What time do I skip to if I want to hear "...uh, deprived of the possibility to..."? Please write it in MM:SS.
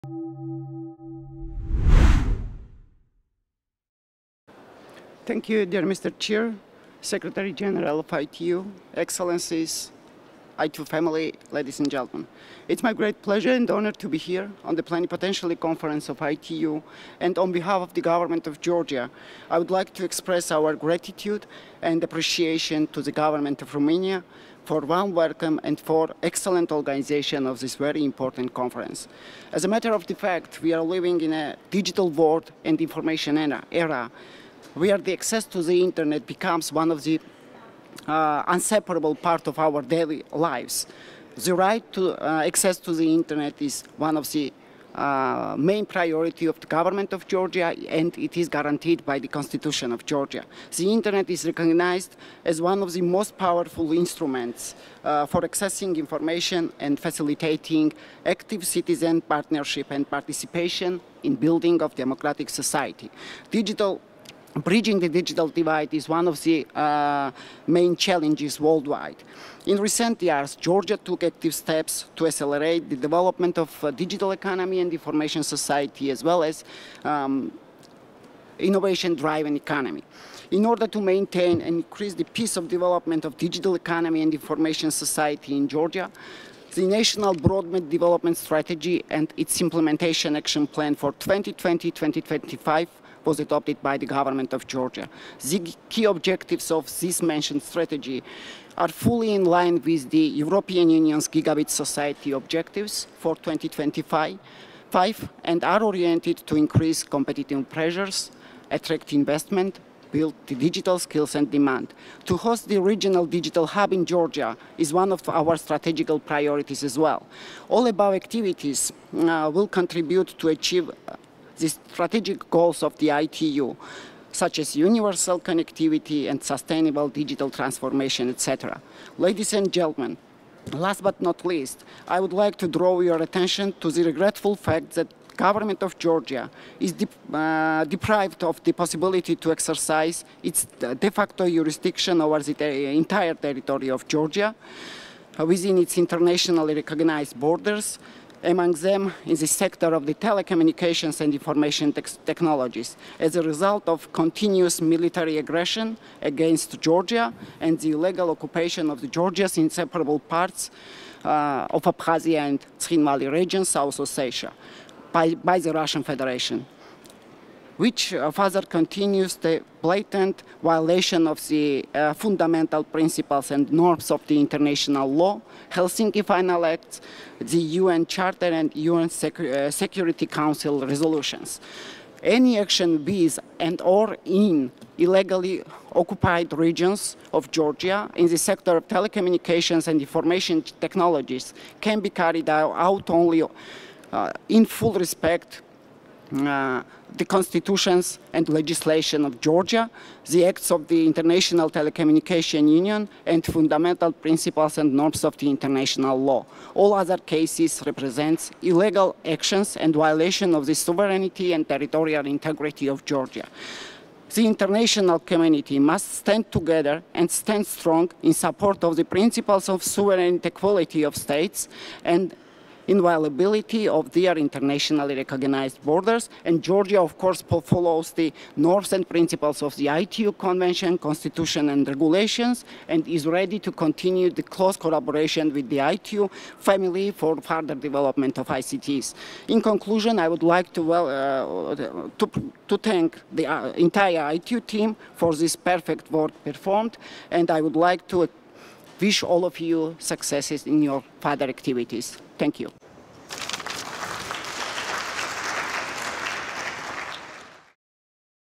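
02:17.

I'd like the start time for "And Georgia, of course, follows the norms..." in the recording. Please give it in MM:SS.
03:46.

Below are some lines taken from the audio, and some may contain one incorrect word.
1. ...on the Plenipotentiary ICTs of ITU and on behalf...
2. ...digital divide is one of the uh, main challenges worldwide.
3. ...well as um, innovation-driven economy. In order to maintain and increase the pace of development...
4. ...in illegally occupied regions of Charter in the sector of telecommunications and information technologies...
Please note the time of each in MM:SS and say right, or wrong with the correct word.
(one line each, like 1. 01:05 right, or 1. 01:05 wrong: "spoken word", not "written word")
1. 00:14 wrong: "Conference", not "ICTs"
2. 01:05 right
3. 01:16 right
4. 03:04 wrong: "Georgia", not "Charter".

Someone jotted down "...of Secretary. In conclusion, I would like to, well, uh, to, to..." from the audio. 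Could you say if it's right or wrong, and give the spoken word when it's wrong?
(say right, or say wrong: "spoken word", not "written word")
wrong: "ICTs", not "Secretary".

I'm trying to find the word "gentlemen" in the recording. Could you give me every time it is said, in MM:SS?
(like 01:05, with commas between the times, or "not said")
00:11, 02:09.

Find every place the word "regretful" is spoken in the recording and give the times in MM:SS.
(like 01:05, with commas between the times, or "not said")
02:14.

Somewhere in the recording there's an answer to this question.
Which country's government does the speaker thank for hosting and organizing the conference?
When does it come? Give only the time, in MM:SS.
00:23.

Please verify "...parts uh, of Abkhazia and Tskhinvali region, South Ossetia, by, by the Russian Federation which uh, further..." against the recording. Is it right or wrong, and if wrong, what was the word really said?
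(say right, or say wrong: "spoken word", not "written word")
right.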